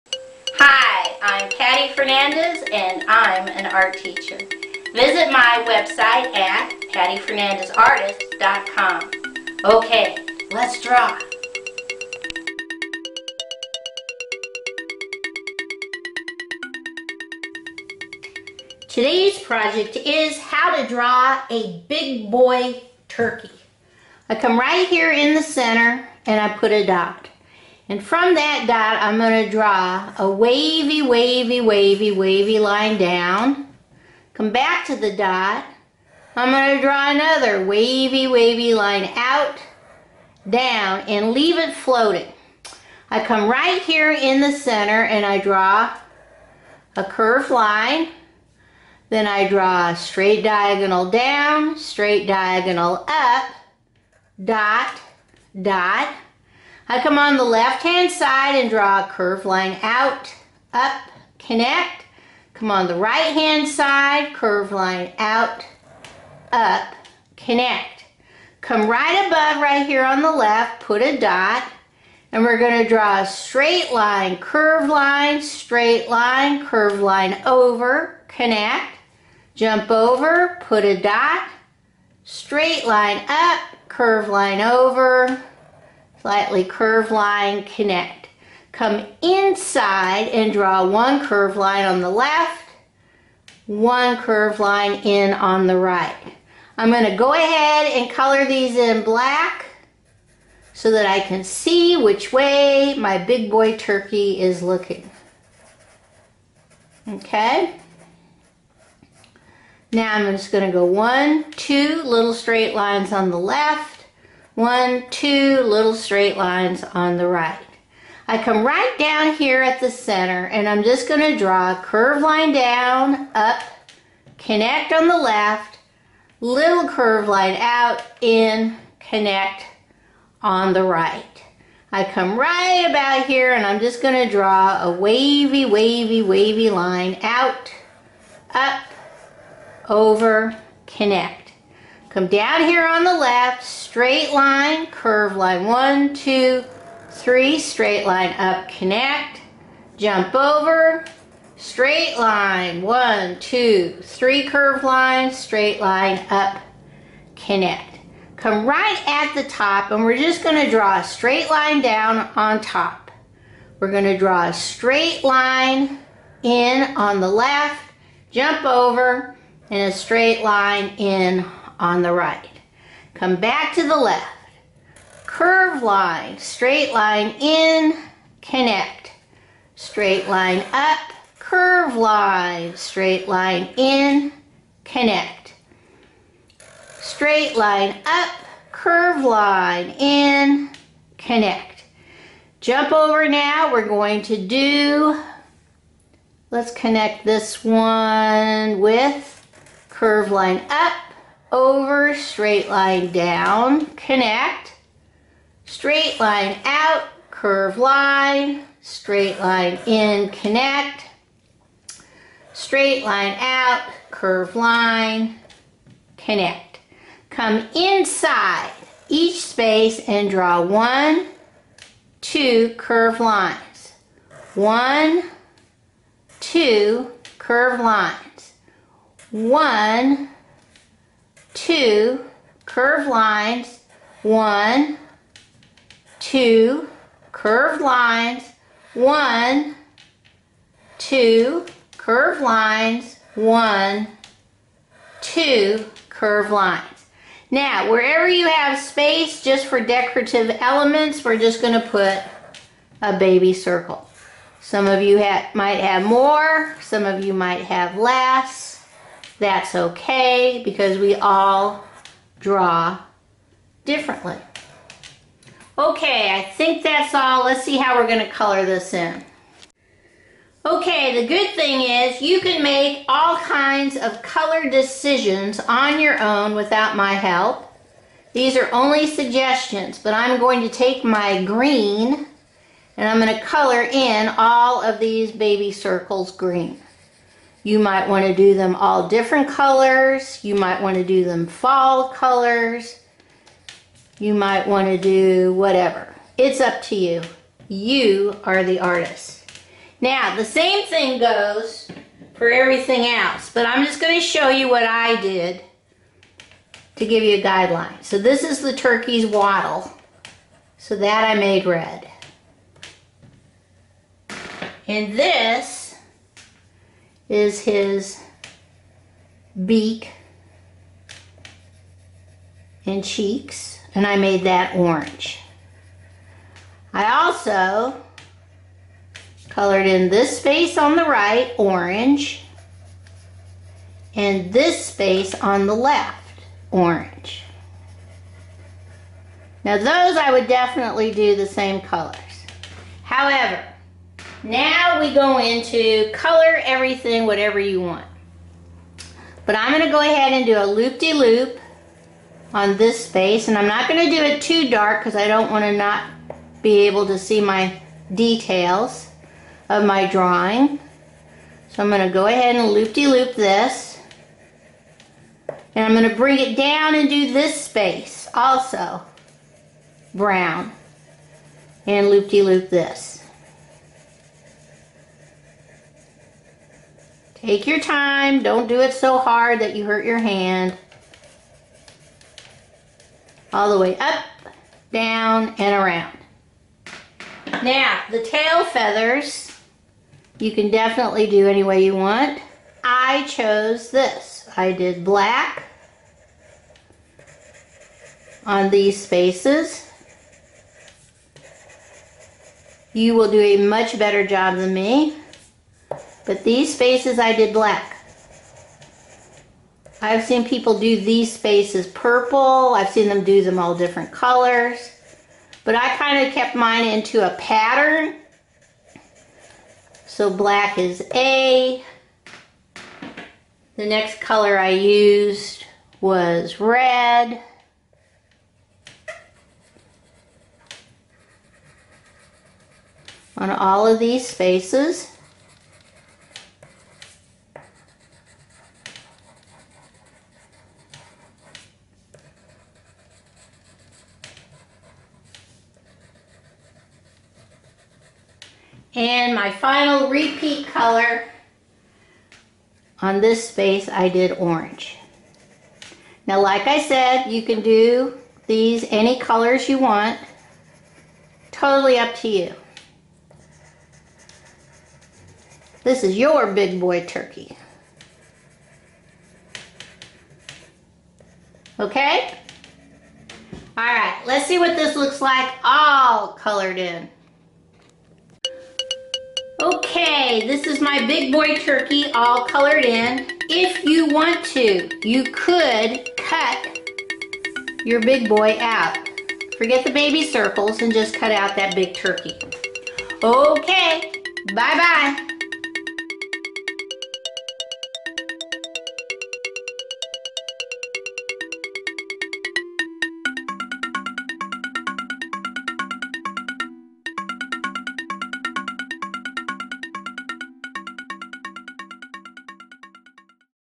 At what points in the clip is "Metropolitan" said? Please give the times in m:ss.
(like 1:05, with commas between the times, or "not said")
not said.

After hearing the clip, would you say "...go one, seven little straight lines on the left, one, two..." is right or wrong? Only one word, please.
wrong.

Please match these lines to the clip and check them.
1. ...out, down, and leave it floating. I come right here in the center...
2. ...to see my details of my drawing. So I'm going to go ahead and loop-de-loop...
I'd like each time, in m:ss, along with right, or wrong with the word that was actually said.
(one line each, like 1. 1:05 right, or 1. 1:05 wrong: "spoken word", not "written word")
1. 0:39 right
2. 5:57 right.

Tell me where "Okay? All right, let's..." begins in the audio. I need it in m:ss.
7:51.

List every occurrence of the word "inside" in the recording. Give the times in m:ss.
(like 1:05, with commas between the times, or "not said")
1:29, 3:37.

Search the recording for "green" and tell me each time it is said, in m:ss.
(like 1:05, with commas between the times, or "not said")
4:41, 4:46.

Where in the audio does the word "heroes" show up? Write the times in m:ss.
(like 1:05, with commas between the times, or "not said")
not said.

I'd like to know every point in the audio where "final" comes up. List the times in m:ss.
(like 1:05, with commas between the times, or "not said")
7:29.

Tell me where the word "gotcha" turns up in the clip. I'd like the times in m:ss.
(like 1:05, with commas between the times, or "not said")
not said.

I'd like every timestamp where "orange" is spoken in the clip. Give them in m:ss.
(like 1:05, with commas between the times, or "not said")
5:24, 5:31, 5:36, 7:34.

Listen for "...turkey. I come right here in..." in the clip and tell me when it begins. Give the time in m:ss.
0:23.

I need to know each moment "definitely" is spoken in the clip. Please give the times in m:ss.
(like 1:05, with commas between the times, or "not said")
5:40, 6:30.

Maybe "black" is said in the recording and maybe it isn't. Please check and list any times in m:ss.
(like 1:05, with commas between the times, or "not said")
1:39, 6:35, 6:47, 7:00.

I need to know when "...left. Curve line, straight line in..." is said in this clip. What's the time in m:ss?
2:53.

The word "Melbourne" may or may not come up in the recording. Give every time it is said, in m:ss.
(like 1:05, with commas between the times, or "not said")
not said.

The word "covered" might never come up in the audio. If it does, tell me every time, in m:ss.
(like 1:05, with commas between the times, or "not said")
not said.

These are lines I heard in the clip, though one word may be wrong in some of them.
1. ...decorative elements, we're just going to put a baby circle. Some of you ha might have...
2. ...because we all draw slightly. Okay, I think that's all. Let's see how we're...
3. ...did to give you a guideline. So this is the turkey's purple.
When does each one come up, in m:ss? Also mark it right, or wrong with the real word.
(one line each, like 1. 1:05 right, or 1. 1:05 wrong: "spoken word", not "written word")
1. 4:09 right
2. 4:20 wrong: "differently", not "slightly"
3. 5:05 wrong: "wattle", not "purple".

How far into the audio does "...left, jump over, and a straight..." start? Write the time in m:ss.
2:47.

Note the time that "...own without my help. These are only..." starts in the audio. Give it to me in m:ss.
4:36.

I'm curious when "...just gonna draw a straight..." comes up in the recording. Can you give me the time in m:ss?
2:40.